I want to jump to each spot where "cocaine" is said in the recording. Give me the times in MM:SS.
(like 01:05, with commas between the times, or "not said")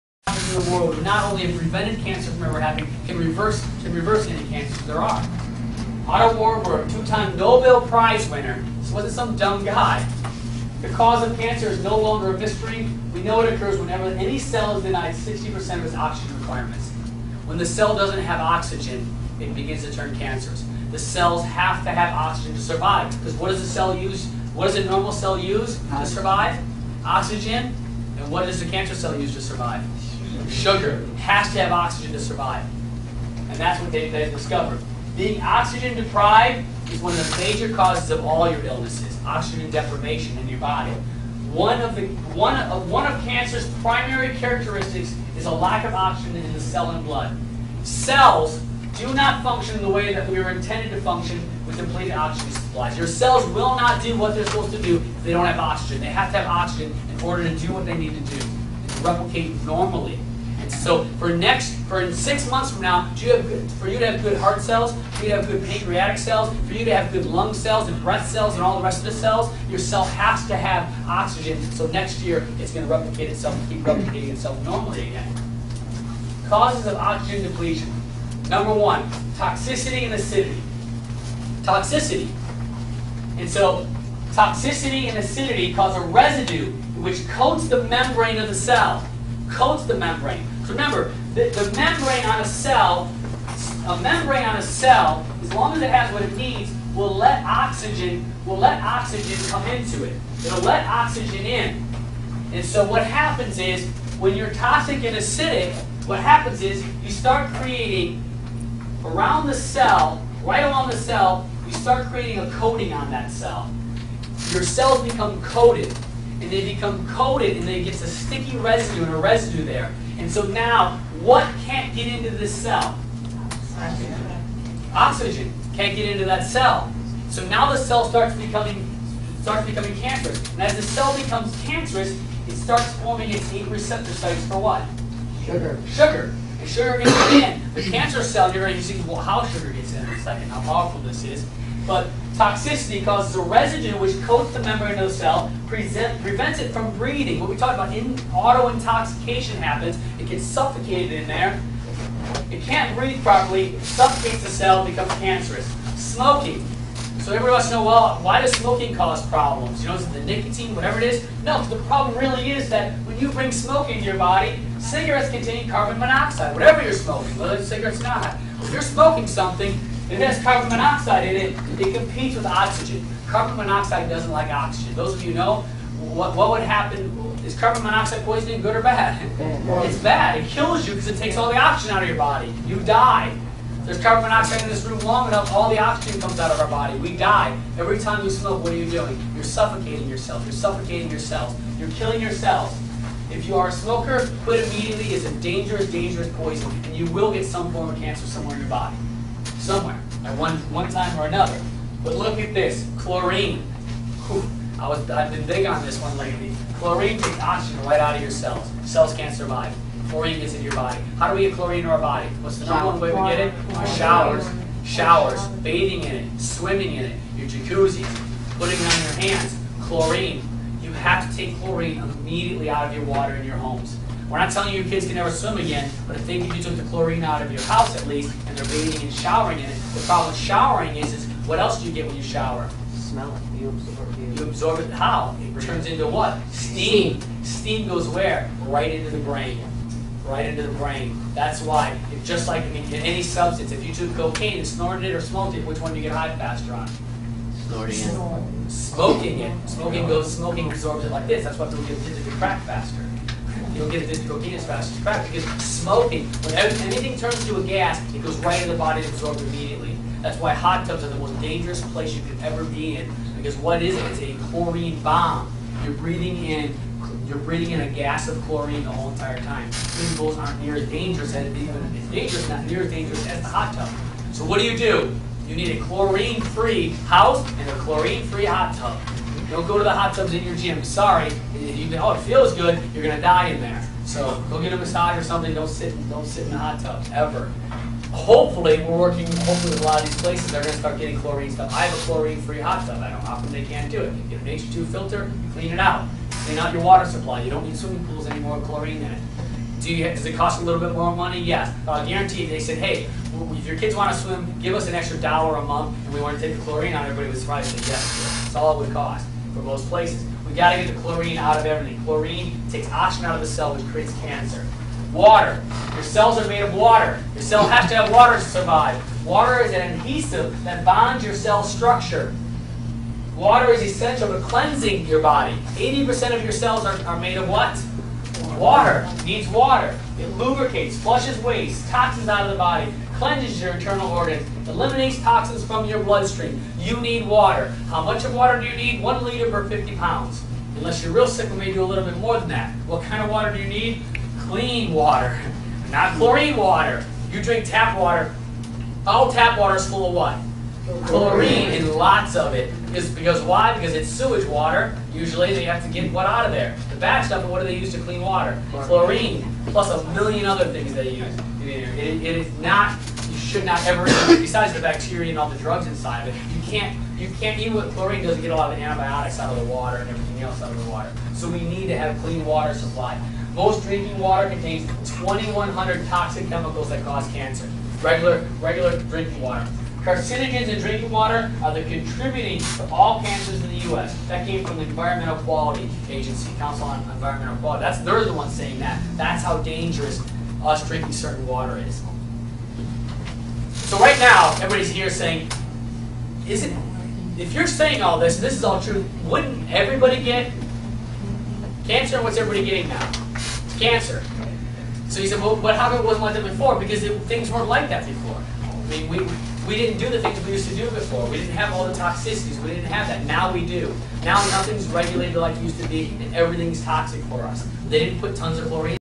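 04:04, 04:14.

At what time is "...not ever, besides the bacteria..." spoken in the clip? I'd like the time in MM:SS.
06:03.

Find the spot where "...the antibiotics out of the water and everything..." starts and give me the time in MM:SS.
06:08.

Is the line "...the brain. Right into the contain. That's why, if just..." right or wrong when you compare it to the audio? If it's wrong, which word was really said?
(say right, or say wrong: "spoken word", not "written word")
wrong: "brain", not "contain".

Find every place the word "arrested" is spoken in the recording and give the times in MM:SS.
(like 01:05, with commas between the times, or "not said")
not said.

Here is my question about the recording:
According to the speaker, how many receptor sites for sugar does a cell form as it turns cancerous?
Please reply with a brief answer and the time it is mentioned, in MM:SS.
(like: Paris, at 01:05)
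8, at 02:13.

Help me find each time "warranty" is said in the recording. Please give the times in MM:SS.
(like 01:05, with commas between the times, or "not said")
not said.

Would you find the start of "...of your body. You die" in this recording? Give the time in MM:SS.
03:02.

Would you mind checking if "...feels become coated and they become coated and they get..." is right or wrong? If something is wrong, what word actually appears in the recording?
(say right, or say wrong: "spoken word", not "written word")
wrong: "cells", not "feels".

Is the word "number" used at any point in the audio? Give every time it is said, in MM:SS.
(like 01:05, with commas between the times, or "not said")
01:18, 03:32.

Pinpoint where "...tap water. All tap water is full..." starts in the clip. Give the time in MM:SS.
05:47.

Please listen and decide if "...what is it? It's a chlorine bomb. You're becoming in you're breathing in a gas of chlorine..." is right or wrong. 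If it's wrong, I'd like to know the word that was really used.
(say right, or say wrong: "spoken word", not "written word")
wrong: "breathing", not "becoming".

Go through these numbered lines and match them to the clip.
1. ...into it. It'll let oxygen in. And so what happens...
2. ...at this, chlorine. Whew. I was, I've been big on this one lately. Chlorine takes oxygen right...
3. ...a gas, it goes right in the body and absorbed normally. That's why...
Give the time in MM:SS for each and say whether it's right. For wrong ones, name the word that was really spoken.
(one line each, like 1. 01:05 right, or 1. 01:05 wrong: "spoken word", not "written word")
1. 01:39 right
2. 03:22 right
3. 04:17 wrong: "immediately", not "normally".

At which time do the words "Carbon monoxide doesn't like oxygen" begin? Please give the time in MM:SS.
02:53.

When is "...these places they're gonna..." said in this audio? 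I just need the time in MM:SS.
04:50.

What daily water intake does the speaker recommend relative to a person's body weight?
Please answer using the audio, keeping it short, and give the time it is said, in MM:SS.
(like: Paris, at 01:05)
1 liter per 50 pounds, at 05:39.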